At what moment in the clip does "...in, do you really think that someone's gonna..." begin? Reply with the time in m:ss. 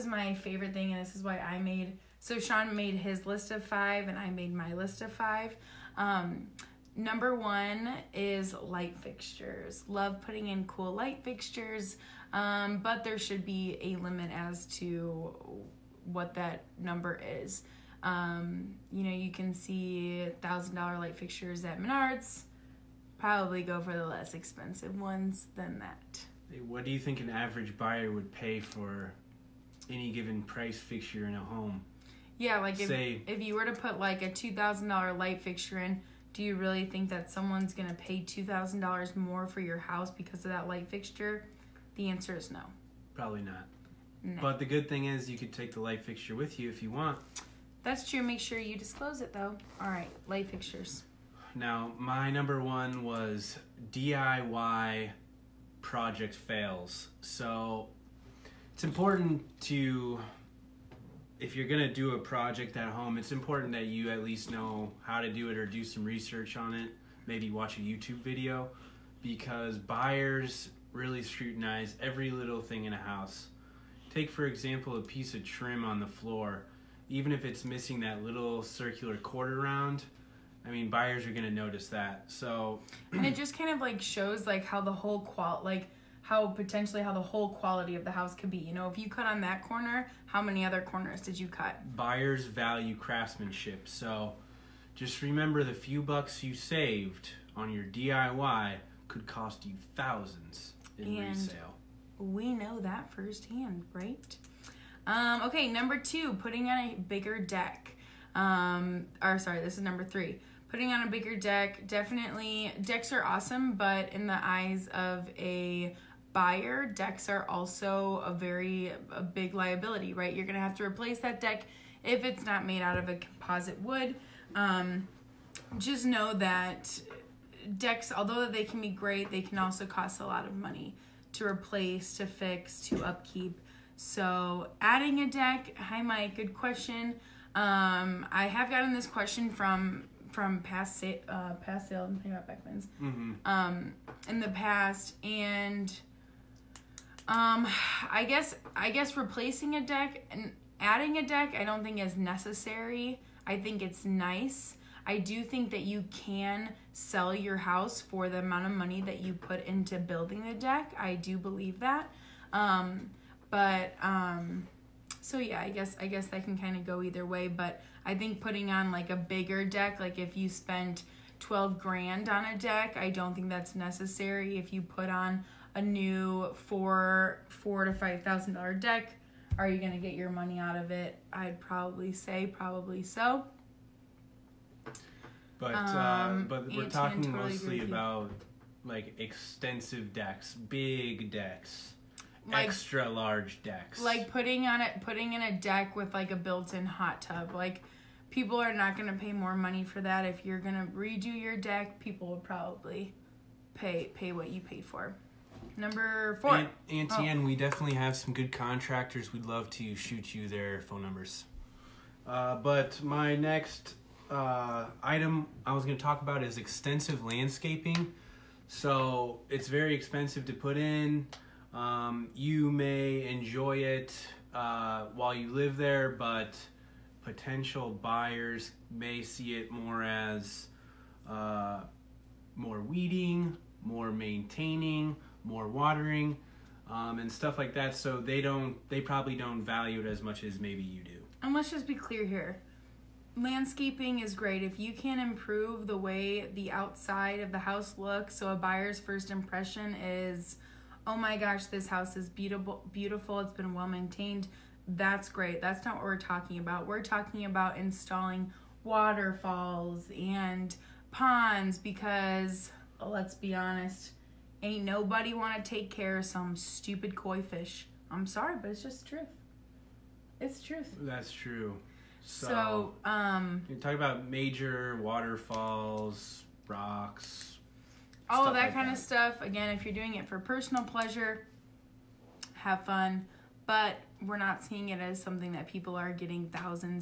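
0:35.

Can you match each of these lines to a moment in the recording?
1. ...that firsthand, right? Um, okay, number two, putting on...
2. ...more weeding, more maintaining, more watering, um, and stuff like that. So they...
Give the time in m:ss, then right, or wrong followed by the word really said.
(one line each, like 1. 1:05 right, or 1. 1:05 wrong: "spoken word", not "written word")
1. 1:42 right
2. 3:52 right.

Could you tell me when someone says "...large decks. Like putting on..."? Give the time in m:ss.
3:13.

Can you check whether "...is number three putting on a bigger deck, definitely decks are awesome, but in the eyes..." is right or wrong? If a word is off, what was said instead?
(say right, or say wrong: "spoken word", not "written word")
right.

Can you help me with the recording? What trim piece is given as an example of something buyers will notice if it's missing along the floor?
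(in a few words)
quarter round.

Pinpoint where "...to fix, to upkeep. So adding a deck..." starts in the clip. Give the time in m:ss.
2:12.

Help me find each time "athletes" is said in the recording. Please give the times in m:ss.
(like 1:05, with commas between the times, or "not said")
not said.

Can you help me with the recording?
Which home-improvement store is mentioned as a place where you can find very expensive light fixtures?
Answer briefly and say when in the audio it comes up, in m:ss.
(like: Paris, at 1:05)
Menards, at 0:21.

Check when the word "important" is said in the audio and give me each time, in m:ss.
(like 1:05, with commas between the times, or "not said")
0:58, 1:03.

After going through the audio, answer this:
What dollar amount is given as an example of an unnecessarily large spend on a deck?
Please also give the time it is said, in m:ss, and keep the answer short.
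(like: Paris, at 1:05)
12 grand, at 2:51.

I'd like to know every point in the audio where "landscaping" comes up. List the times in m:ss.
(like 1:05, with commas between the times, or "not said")
3:37, 4:03.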